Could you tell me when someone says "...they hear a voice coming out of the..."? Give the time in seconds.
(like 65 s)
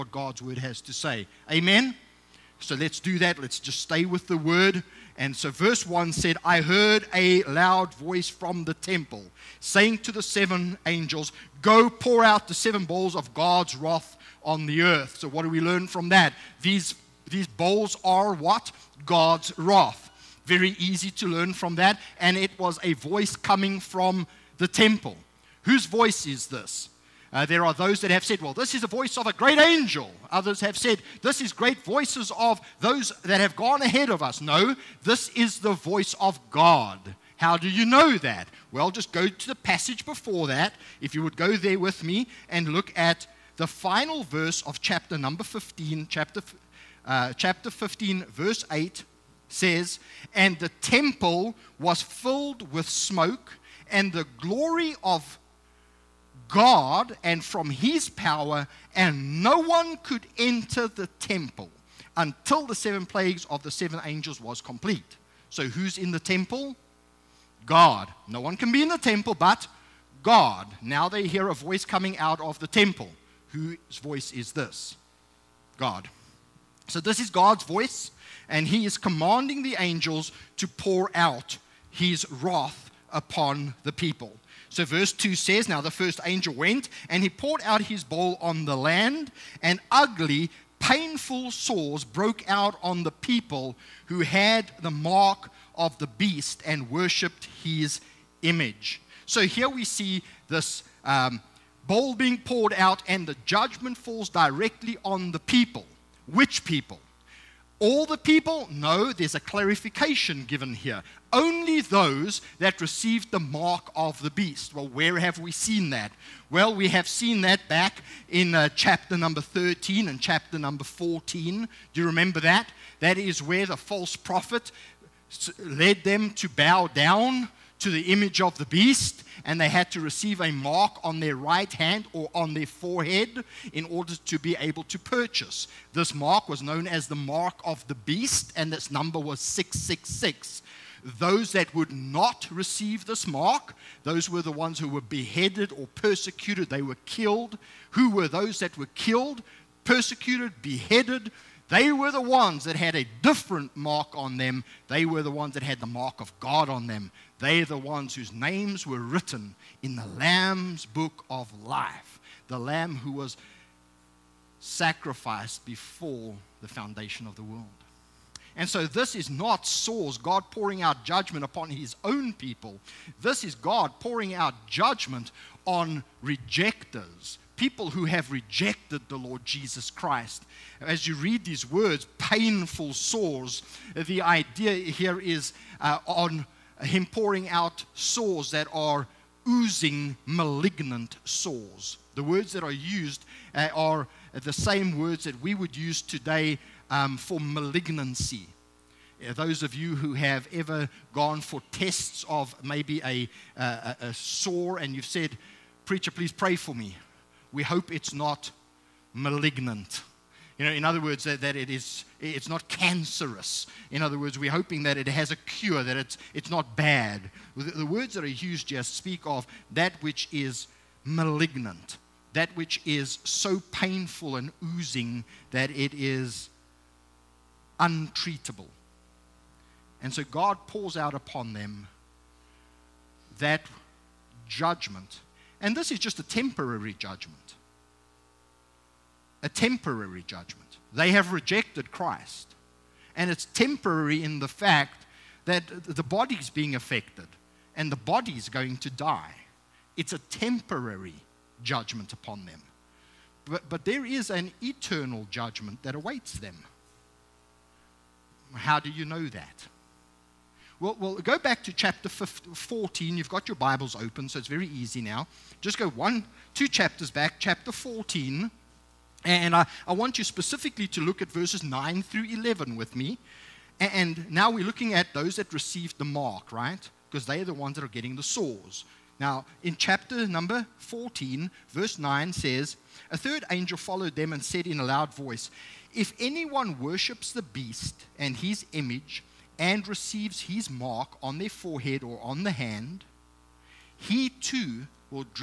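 71 s.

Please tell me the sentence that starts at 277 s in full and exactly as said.
Because they're the ones that are getting the sores.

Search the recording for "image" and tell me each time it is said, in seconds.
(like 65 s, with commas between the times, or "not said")
98 s, 128 s, 288 s.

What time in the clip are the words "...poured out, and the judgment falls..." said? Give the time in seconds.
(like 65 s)
102 s.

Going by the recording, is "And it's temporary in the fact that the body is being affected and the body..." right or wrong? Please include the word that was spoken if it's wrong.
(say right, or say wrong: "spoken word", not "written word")
right.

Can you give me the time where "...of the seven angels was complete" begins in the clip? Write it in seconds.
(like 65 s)
63 s.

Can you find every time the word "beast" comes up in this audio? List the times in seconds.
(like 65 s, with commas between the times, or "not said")
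96 s, 114 s, 128 s, 137 s, 287 s.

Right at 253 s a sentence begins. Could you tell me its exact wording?
But, but there is an eternal judgment that awaits them.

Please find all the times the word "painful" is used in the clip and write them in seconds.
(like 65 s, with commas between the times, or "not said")
90 s, 182 s, 223 s.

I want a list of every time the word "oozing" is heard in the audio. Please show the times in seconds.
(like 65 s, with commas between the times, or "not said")
189 s, 224 s.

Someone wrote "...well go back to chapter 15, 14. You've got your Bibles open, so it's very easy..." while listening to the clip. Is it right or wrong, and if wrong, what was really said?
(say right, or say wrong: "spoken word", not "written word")
right.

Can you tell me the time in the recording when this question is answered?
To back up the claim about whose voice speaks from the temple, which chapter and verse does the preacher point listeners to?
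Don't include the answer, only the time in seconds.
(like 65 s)
47 s.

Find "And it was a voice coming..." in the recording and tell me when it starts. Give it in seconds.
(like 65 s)
22 s.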